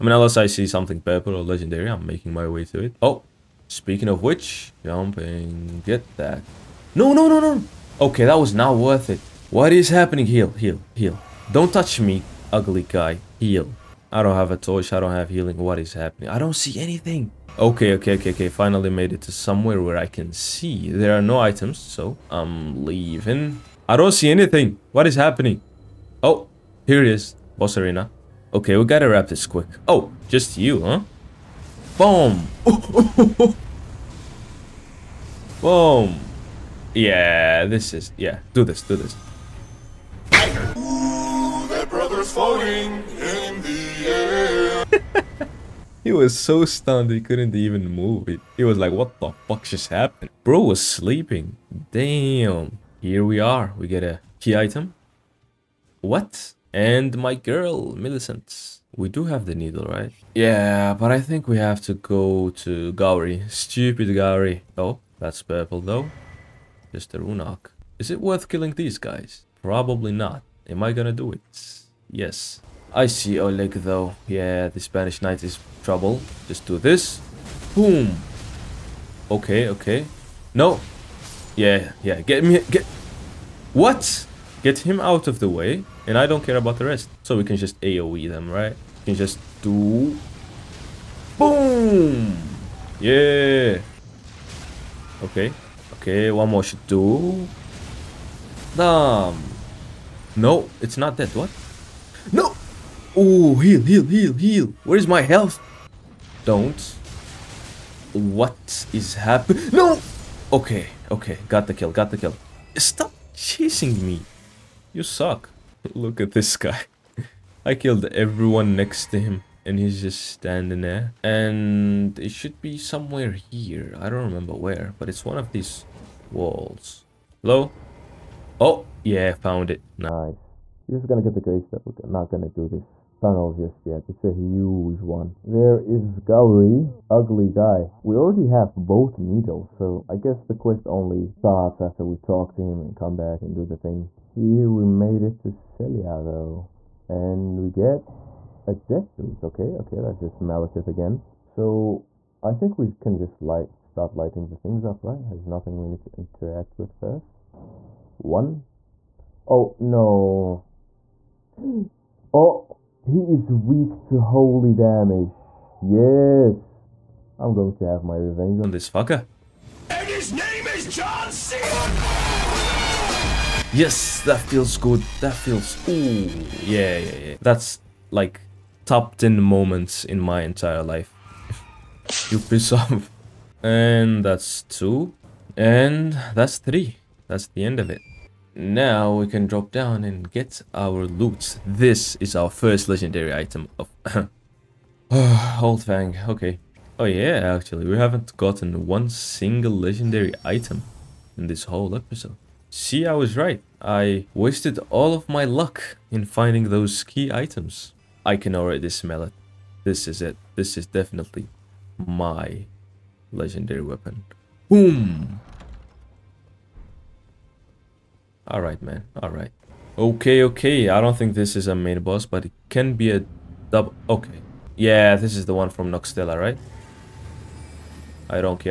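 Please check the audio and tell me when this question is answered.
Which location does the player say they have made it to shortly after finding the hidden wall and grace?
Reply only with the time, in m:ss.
2:25.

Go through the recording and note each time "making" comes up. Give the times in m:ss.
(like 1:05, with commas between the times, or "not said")
0:02.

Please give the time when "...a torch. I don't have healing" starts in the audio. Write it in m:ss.
0:14.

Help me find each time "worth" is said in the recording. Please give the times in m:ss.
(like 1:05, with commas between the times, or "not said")
0:08, 1:08.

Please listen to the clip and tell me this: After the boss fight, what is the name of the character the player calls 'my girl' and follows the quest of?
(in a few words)
Millicent.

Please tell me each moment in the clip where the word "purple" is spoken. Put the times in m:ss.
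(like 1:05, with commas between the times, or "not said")
0:00, 1:05.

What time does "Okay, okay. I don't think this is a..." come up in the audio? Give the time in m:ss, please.
3:39.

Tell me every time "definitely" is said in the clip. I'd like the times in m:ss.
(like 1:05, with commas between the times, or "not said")
3:30.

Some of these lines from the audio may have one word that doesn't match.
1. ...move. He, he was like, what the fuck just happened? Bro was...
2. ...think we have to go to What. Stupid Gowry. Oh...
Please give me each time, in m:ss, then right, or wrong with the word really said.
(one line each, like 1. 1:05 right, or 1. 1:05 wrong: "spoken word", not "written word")
1. 0:47 right
2. 1:01 wrong: "Gowry", not "What".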